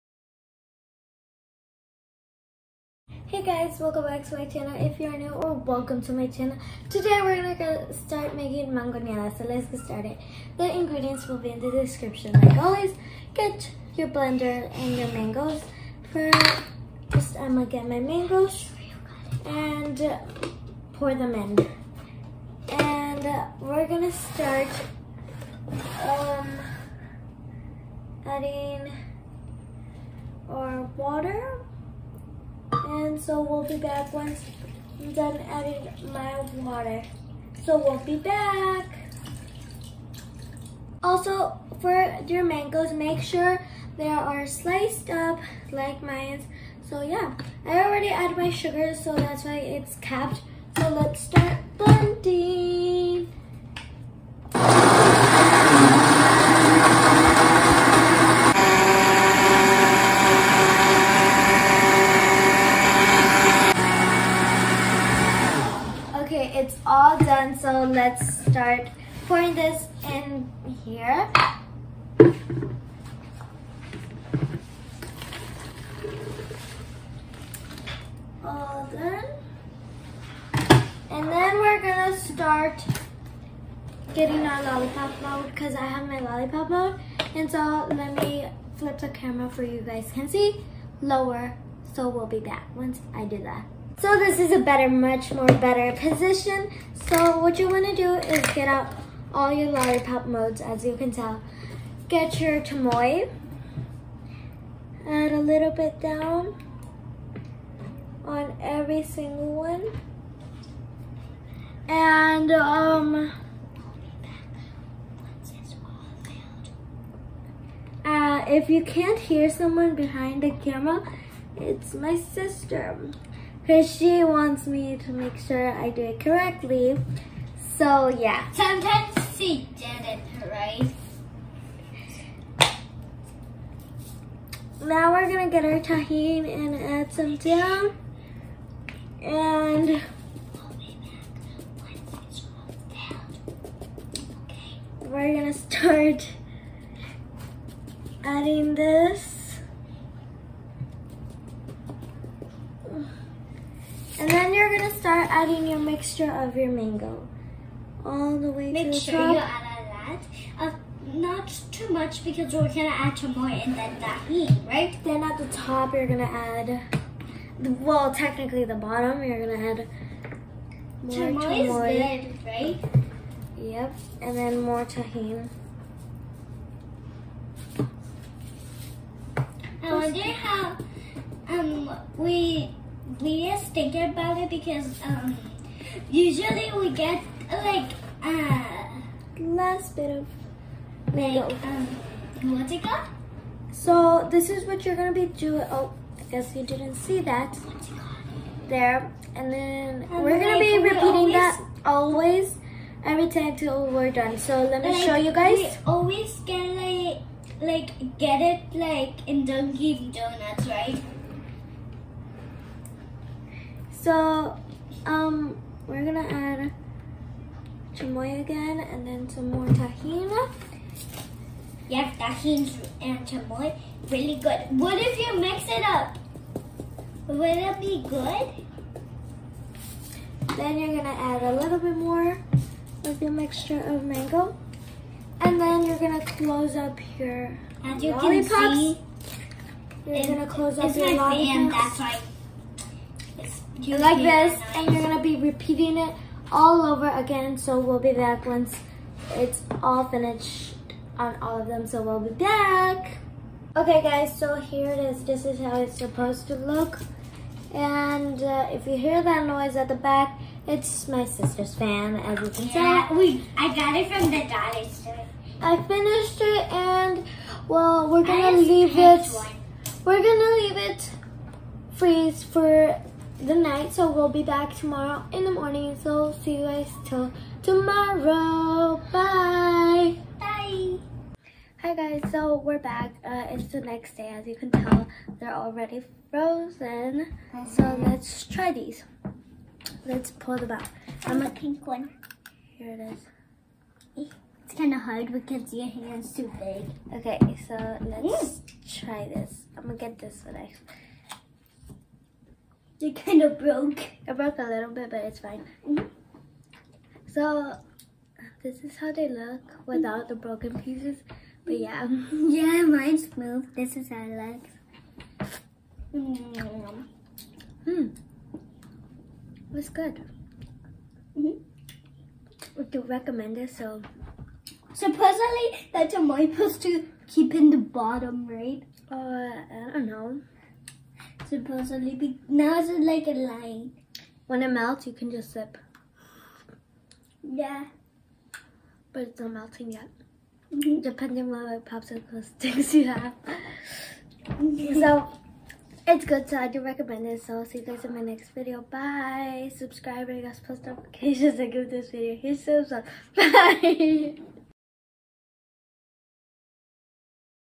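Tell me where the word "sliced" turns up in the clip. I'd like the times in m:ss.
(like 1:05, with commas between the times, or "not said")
0:44.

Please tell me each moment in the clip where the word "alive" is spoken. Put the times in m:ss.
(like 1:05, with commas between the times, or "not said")
not said.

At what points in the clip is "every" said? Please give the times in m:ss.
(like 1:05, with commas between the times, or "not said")
1:48, 3:23.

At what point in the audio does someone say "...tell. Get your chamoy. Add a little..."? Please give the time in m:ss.
1:41.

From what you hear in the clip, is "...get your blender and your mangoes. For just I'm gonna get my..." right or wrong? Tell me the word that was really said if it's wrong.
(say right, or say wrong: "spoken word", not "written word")
right.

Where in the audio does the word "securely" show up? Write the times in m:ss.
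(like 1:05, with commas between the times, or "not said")
not said.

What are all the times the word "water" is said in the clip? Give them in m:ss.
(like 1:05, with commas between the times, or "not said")
0:30, 0:36.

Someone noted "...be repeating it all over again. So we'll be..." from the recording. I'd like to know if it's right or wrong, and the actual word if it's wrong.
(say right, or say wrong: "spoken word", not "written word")
right.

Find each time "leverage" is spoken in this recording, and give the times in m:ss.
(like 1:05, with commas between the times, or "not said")
not said.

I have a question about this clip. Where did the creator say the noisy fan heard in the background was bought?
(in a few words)
the dollar store.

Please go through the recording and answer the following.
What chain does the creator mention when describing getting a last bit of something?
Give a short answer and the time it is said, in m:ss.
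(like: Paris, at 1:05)
Dunkin' Donuts, at 3:29.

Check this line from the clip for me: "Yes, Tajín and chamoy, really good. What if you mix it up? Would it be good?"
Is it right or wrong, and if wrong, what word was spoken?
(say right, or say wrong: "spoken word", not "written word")
right.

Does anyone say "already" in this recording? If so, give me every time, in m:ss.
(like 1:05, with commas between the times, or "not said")
0:47, 4:45.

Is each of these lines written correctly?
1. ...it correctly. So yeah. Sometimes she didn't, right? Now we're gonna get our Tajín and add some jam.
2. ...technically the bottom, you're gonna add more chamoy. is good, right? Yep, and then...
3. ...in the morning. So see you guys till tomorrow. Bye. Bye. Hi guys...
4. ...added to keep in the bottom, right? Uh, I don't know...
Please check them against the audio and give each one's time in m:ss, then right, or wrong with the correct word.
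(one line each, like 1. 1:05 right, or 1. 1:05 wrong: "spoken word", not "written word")
1. 2:06 right
2. 2:48 right
3. 4:35 right
4. 5:26 wrong: "supposed", not "added".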